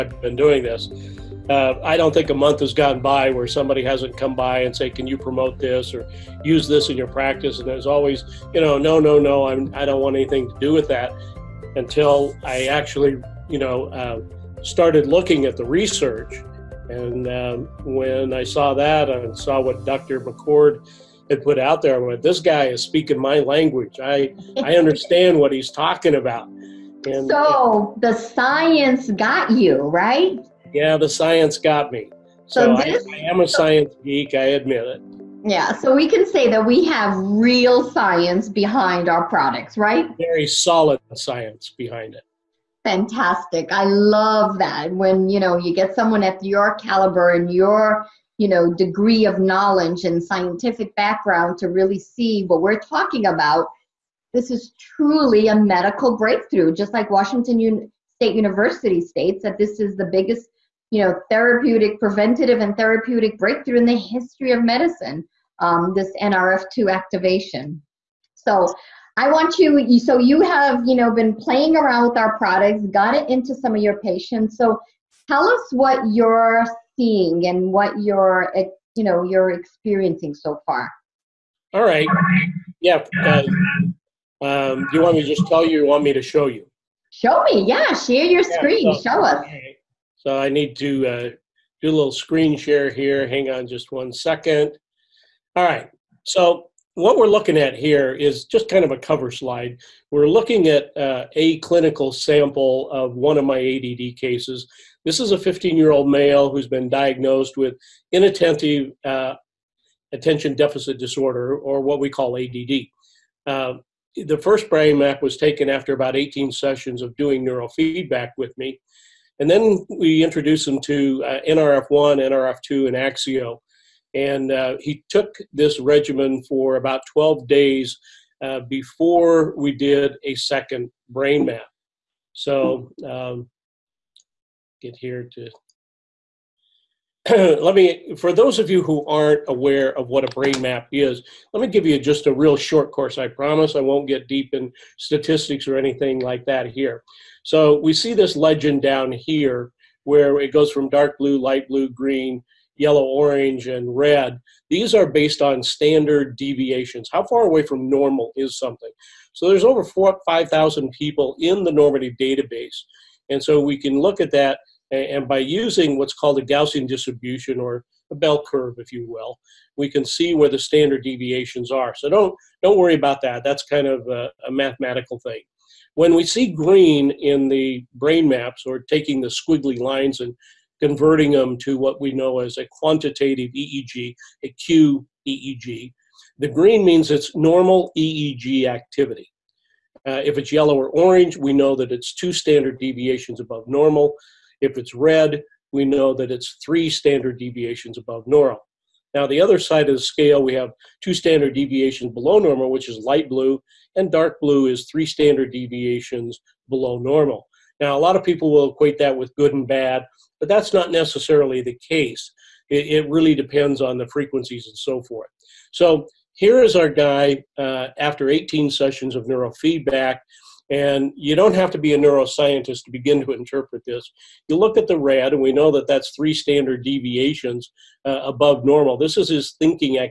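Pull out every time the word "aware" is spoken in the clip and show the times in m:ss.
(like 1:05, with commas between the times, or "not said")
2:19.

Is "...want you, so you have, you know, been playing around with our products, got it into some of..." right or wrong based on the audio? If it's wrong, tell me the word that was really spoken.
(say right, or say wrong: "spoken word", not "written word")
right.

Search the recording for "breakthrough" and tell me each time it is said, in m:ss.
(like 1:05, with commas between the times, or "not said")
0:56, 1:03.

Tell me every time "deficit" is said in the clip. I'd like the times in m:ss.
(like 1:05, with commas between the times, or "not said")
1:50.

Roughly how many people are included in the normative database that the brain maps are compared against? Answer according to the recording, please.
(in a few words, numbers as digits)
5,000.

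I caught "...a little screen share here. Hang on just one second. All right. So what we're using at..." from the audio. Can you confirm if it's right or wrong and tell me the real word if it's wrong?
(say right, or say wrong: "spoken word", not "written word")
wrong: "looking", not "using".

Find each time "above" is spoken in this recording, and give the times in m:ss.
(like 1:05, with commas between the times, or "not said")
3:13, 3:17, 3:48.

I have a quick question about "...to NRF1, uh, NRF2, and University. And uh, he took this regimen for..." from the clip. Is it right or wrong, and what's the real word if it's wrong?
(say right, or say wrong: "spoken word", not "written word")
wrong: "Axio", not "University".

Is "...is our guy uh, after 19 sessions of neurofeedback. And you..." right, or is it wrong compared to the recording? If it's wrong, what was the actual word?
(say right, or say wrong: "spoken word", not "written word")
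wrong: "18", not "19".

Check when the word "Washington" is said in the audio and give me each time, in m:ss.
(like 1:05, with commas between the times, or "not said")
0:57.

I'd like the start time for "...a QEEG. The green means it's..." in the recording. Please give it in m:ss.
3:04.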